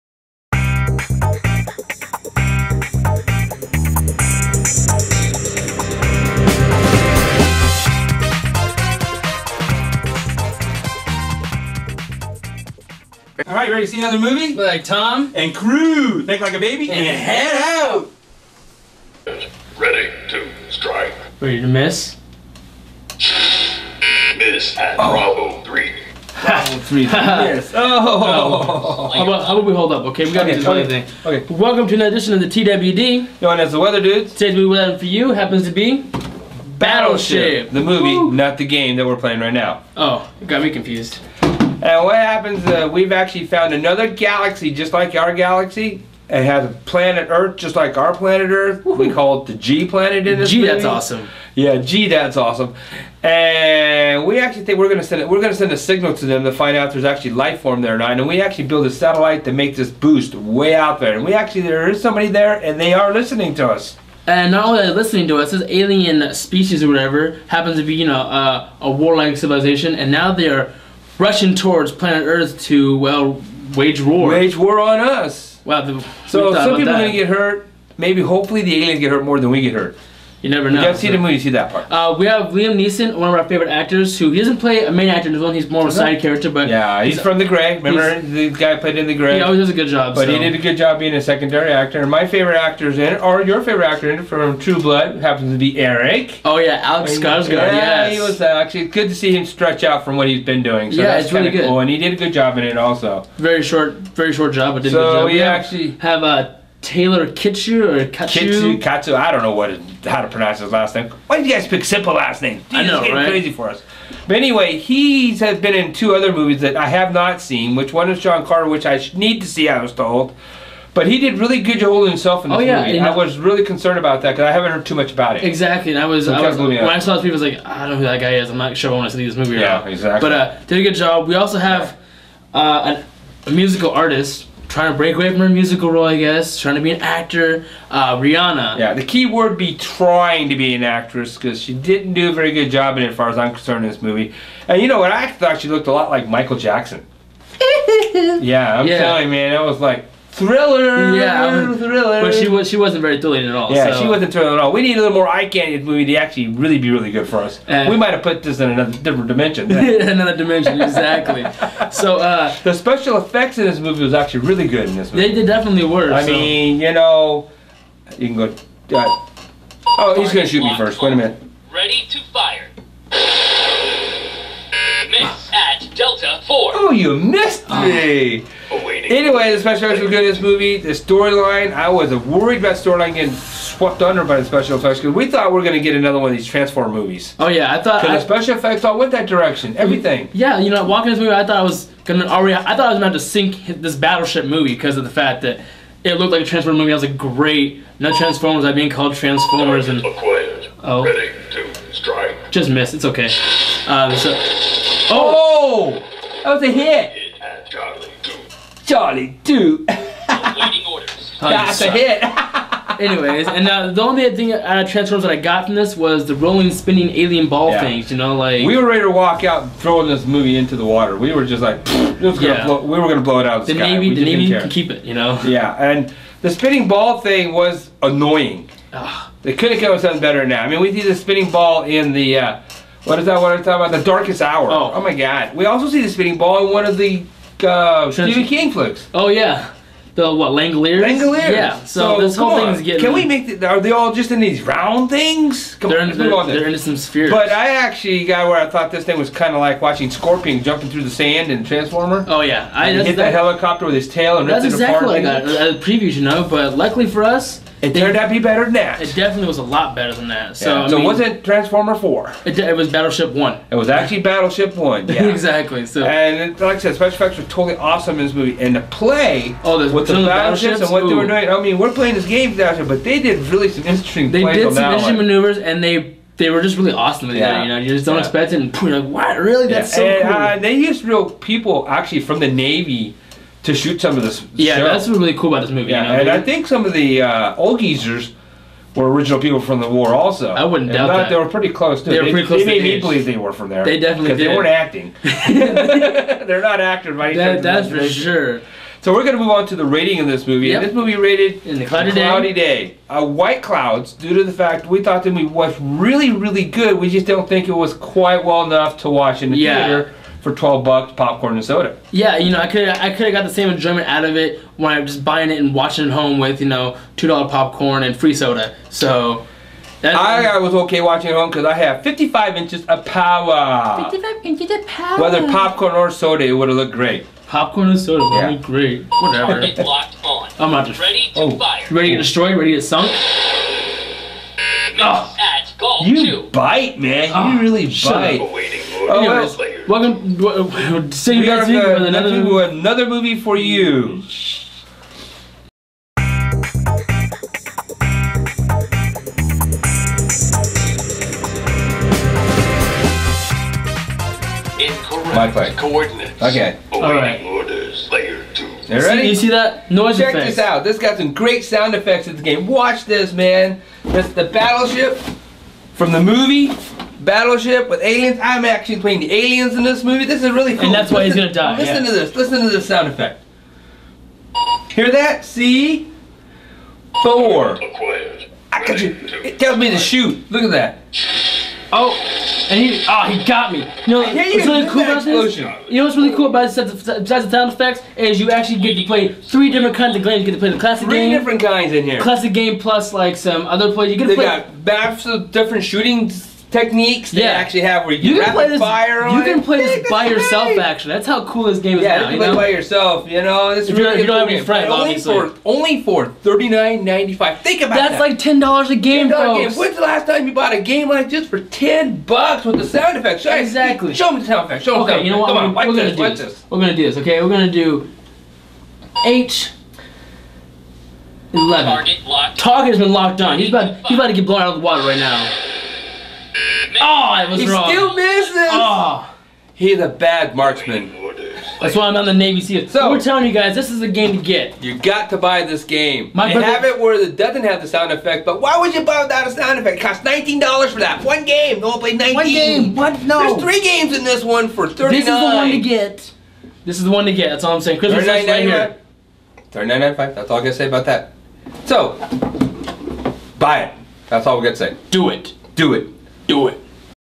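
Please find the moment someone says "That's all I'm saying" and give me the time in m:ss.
7:27.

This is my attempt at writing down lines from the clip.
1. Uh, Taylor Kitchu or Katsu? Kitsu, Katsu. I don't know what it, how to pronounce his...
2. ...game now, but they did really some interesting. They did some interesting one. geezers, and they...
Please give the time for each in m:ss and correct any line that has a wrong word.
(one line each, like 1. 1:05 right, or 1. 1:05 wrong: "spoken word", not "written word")
1. 1:46 right
2. 4:32 wrong: "maneuvers", not "geezers".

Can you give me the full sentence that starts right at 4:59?
So we're going to move on to the rating of this movie.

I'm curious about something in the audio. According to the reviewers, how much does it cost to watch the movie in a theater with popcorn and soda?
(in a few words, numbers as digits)
12 bucks.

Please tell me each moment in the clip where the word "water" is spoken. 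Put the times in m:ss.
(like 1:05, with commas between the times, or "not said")
3:40, 7:04.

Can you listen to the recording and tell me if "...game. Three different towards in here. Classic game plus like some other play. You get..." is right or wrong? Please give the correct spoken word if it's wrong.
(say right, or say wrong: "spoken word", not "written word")
wrong: "kinds", not "towards".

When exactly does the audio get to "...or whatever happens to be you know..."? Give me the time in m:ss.
1:06.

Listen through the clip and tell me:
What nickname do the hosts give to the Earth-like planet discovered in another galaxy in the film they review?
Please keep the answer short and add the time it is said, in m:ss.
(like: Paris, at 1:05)
G planet, at 0:49.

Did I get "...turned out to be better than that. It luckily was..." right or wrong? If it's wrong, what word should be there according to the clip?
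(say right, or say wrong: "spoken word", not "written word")
wrong: "definitely", not "luckily".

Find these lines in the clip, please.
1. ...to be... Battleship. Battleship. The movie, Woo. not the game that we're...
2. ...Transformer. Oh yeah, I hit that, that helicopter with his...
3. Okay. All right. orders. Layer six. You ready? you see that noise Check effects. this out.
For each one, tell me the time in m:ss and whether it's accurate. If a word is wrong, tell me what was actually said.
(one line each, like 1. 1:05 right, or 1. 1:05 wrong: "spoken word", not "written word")
1. 0:35 right
2. 4:11 right
3. 5:56 wrong: "two", not "six".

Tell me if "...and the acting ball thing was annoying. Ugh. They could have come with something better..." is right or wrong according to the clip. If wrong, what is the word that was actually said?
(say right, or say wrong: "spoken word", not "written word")
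wrong: "spinning", not "acting".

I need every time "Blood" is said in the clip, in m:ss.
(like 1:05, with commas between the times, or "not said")
1:34.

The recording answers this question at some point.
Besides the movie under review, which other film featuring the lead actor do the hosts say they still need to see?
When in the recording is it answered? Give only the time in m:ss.
1:58.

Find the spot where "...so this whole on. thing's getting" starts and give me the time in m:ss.
4:02.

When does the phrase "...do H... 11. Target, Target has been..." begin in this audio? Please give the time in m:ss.
6:57.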